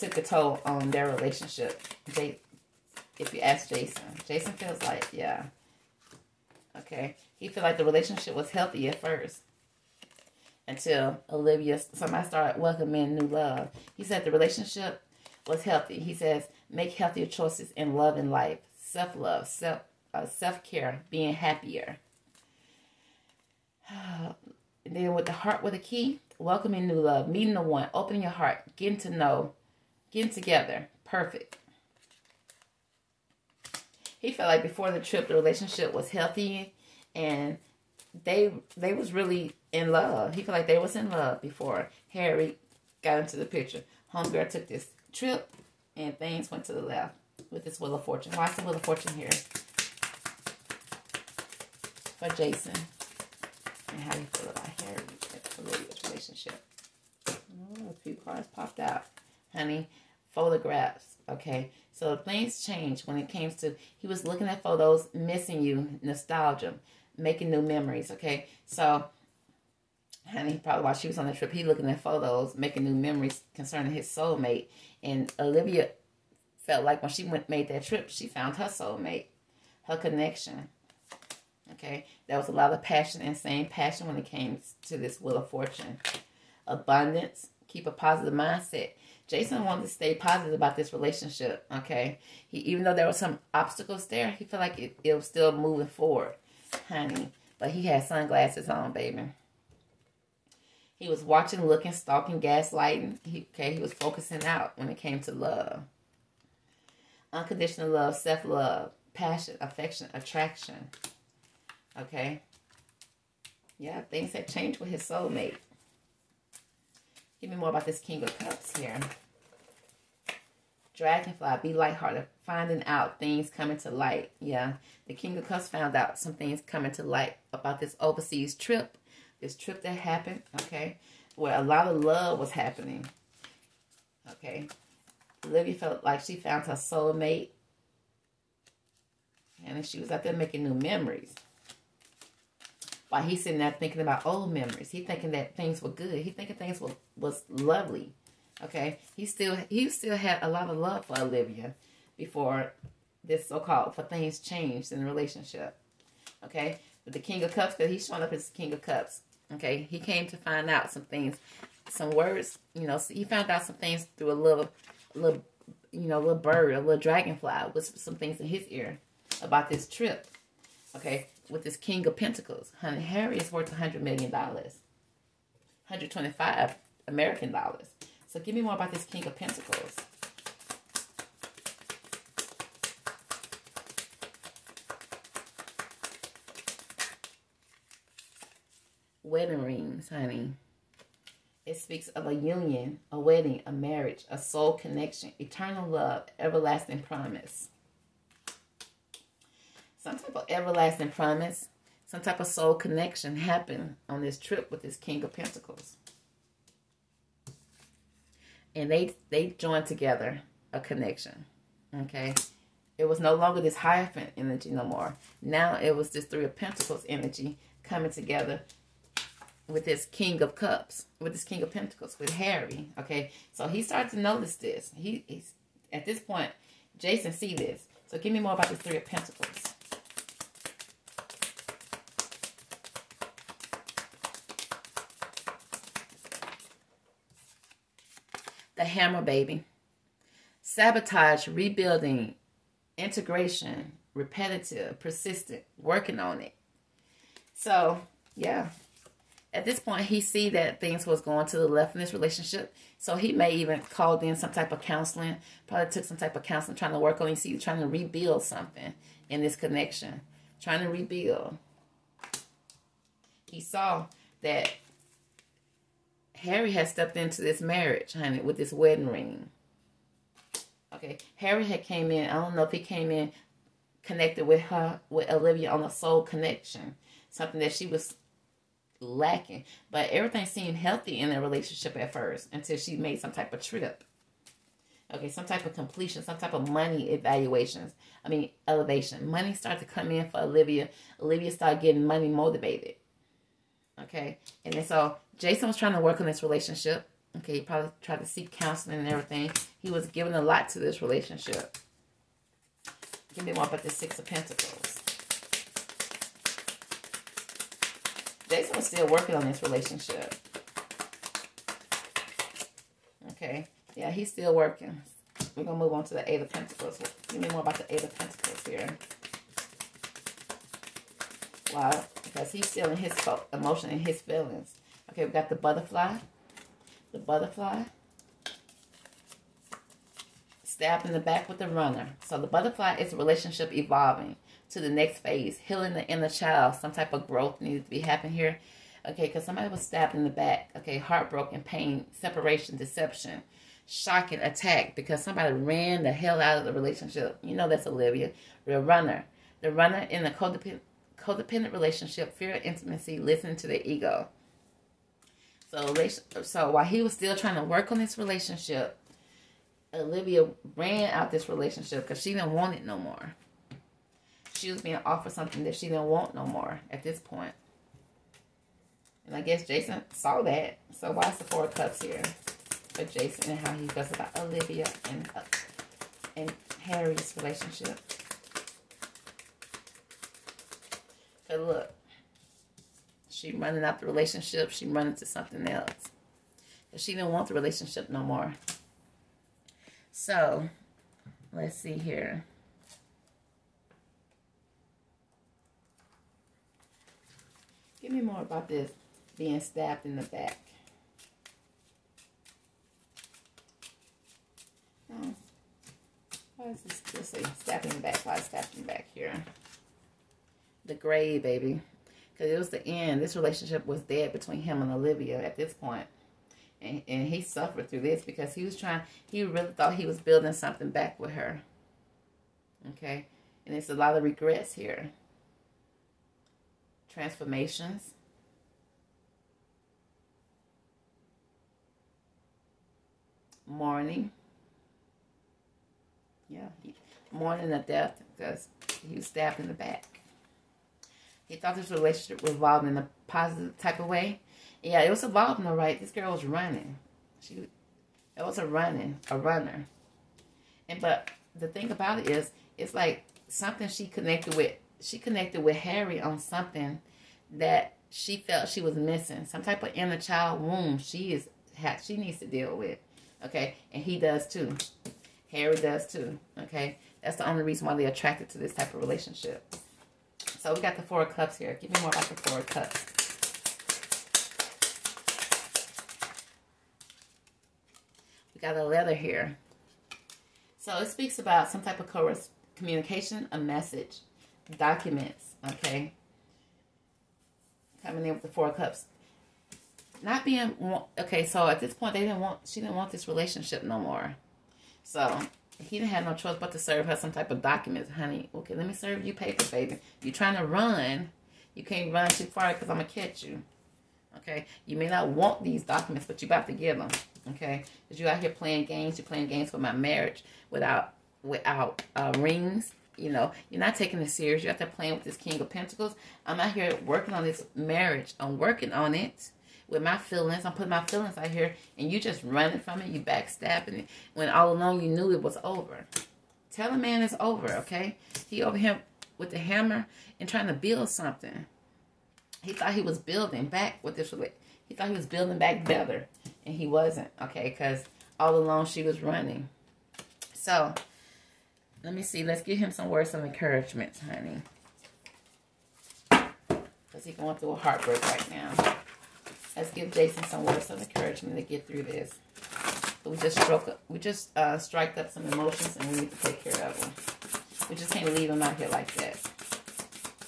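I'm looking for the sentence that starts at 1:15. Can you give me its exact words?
And Olivia felt like when she went made that trip, she found her soulmate, her connection.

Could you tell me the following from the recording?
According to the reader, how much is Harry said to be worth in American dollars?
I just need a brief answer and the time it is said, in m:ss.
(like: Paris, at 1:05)
125, at 2:55.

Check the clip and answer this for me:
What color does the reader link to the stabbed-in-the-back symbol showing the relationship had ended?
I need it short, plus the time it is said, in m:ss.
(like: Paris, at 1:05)
Gray, at 6:50.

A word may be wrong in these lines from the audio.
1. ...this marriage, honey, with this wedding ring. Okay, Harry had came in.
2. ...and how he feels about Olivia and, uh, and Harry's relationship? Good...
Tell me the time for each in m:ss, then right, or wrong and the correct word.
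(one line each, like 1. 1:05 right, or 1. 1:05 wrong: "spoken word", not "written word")
1. 4:27 right
2. 6:13 right.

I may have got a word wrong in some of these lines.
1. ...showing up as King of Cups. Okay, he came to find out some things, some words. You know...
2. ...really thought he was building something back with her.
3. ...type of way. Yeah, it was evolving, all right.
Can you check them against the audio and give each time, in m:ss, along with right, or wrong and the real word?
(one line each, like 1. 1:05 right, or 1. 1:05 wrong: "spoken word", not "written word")
1. 2:38 right
2. 6:59 right
3. 7:23 right.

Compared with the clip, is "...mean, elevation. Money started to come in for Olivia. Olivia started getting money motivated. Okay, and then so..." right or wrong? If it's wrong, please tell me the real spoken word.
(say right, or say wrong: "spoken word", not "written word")
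right.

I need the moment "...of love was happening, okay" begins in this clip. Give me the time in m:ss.
2:11.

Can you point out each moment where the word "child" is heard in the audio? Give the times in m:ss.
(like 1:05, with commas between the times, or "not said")
5:36, 7:40.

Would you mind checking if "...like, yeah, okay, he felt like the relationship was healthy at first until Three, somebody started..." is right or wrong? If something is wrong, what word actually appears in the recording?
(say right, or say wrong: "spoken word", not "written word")
wrong: "Olivia", not "Three".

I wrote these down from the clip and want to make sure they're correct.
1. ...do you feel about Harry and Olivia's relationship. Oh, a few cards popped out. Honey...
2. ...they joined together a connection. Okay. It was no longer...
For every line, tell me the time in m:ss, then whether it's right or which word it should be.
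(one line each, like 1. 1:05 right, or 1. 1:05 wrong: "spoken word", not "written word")
1. 0:54 right
2. 3:29 right.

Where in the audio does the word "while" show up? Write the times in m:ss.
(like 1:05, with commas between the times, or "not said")
1:10, 2:23, 5:56.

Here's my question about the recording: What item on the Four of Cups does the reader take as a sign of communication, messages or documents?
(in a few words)
A letter.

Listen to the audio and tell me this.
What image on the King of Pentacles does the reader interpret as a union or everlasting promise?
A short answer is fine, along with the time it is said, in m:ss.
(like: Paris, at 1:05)
Wedding rings, at 3:09.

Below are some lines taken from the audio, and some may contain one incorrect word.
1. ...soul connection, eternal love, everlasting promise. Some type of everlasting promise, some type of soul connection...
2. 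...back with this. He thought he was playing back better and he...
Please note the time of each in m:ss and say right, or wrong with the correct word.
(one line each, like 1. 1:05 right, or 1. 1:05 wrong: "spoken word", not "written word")
1. 3:14 right
2. 8:53 wrong: "building", not "playing".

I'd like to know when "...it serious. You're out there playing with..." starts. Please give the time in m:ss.
8:34.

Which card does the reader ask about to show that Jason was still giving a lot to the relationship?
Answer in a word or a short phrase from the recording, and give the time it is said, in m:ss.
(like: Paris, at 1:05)
Six of Pentacles, at 5:03.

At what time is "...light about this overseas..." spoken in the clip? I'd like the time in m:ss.
2:07.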